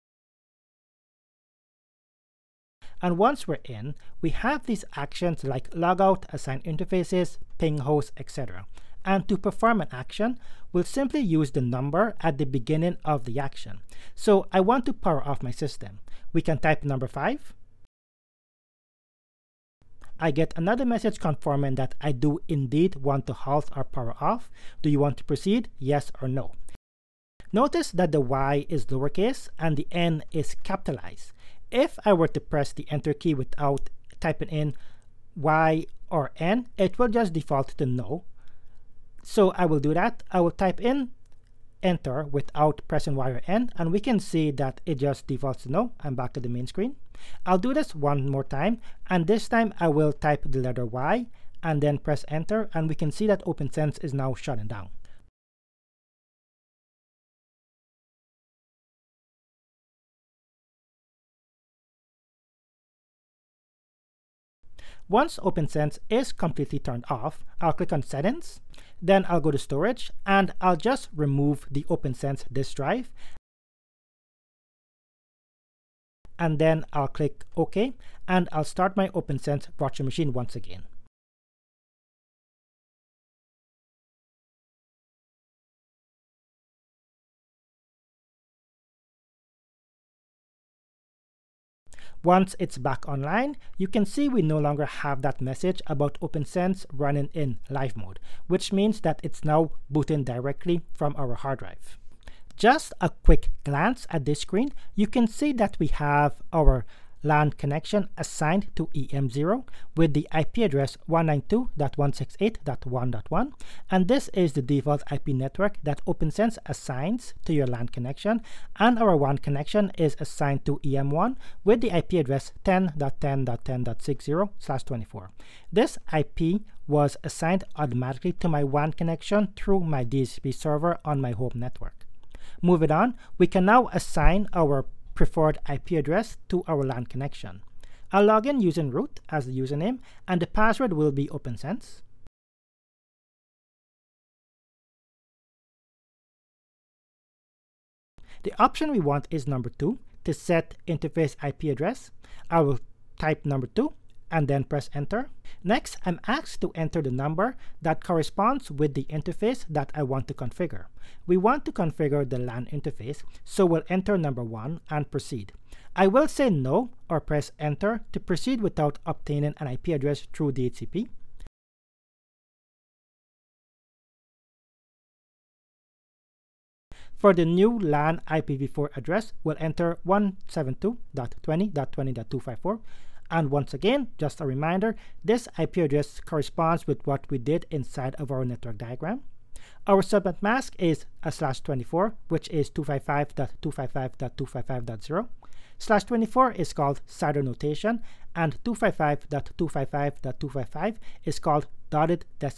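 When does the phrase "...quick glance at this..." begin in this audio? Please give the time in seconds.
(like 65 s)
103 s.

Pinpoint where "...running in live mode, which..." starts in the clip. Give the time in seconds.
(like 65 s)
96 s.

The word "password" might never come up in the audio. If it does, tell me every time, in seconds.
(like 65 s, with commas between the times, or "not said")
140 s.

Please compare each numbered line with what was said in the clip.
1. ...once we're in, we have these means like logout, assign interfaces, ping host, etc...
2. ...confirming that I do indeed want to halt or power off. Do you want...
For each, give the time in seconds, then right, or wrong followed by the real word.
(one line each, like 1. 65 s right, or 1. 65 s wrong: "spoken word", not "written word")
1. 3 s wrong: "actions", not "means"
2. 21 s right.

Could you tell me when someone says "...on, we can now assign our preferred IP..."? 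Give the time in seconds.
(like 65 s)
132 s.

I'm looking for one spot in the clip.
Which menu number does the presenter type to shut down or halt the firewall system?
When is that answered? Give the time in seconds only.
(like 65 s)
16 s.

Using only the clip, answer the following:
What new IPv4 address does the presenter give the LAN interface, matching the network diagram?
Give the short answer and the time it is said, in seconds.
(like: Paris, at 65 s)
172.20.20.254, at 180 s.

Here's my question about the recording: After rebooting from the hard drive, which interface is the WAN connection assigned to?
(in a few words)
EM1.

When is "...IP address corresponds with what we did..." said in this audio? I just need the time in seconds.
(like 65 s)
185 s.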